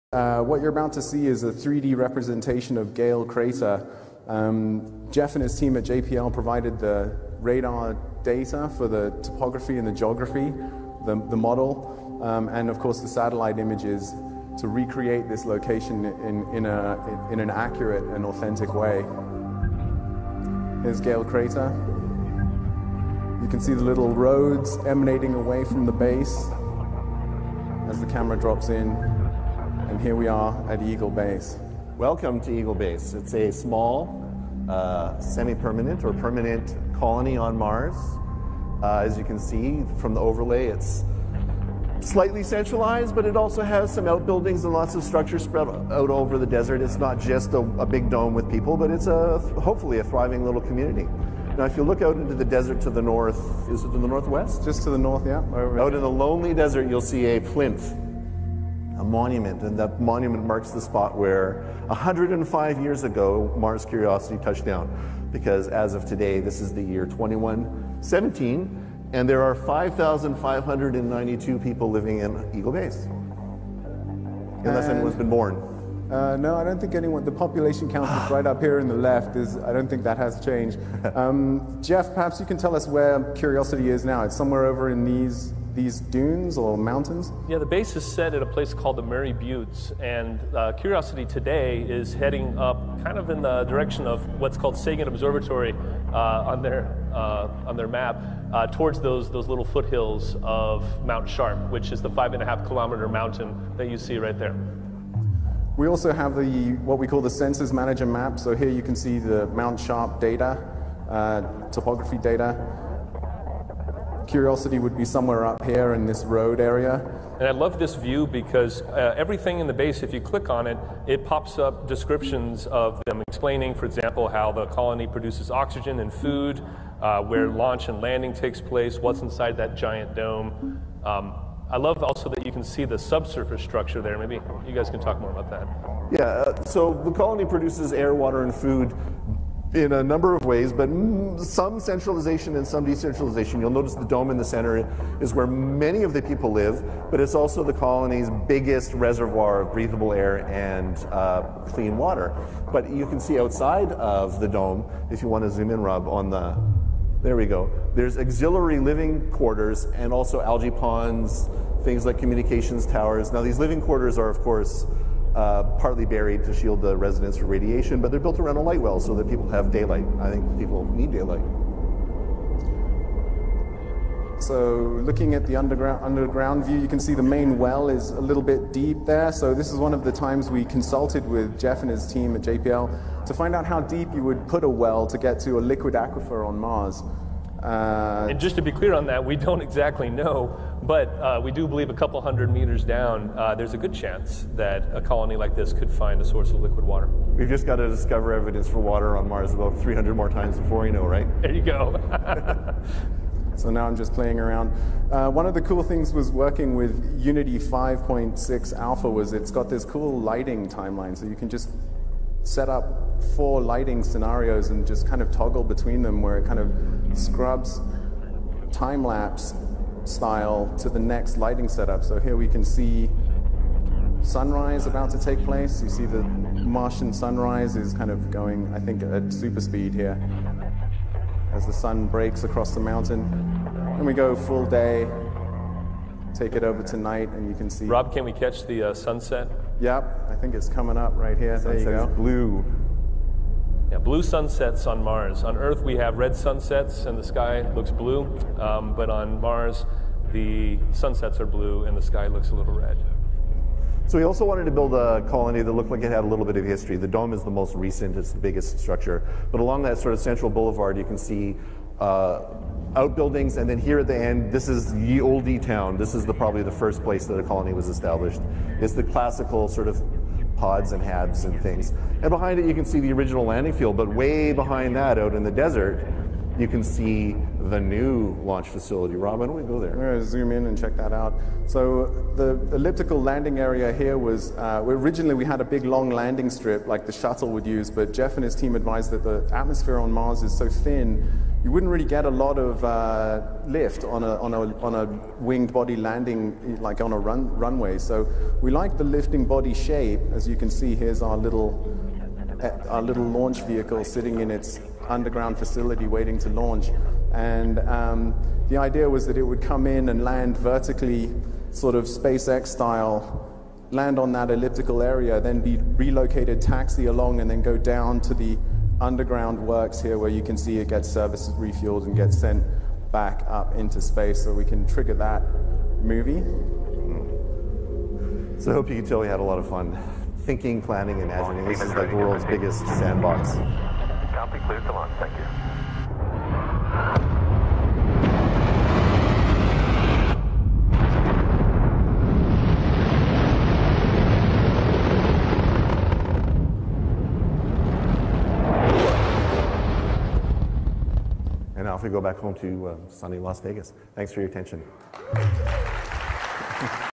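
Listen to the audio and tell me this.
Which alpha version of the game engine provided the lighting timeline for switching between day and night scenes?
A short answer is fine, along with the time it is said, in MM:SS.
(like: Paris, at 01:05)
Unity 5.6, at 03:27.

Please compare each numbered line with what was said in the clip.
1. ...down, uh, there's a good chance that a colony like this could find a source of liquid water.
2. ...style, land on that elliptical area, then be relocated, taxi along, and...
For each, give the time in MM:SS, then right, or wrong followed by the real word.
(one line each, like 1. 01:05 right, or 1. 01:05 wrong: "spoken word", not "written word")
1. 03:12 right
2. 05:12 right.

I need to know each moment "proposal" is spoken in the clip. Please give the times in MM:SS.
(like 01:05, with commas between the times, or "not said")
not said.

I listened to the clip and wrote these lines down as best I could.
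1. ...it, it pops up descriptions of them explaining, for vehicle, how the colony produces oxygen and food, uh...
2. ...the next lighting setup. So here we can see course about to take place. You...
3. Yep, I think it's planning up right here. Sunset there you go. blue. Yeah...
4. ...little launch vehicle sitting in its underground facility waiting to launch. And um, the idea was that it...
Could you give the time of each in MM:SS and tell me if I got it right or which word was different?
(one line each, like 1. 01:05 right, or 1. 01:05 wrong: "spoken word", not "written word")
1. 02:00 wrong: "example", not "vehicle"
2. 03:40 wrong: "sunrise", not "course"
3. 03:59 wrong: "coming", not "planning"
4. 05:03 right.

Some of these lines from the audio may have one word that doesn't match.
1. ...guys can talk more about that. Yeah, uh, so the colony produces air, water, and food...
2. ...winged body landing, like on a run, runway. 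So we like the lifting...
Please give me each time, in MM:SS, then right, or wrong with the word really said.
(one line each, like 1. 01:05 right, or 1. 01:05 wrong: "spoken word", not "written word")
1. 02:14 right
2. 04:55 right.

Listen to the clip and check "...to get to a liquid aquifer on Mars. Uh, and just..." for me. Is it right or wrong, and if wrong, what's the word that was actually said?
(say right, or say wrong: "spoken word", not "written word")
right.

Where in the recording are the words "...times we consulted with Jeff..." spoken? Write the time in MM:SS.
03:00.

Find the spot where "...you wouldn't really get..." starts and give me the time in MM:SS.
04:51.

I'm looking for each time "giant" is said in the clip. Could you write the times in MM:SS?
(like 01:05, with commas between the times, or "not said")
02:09.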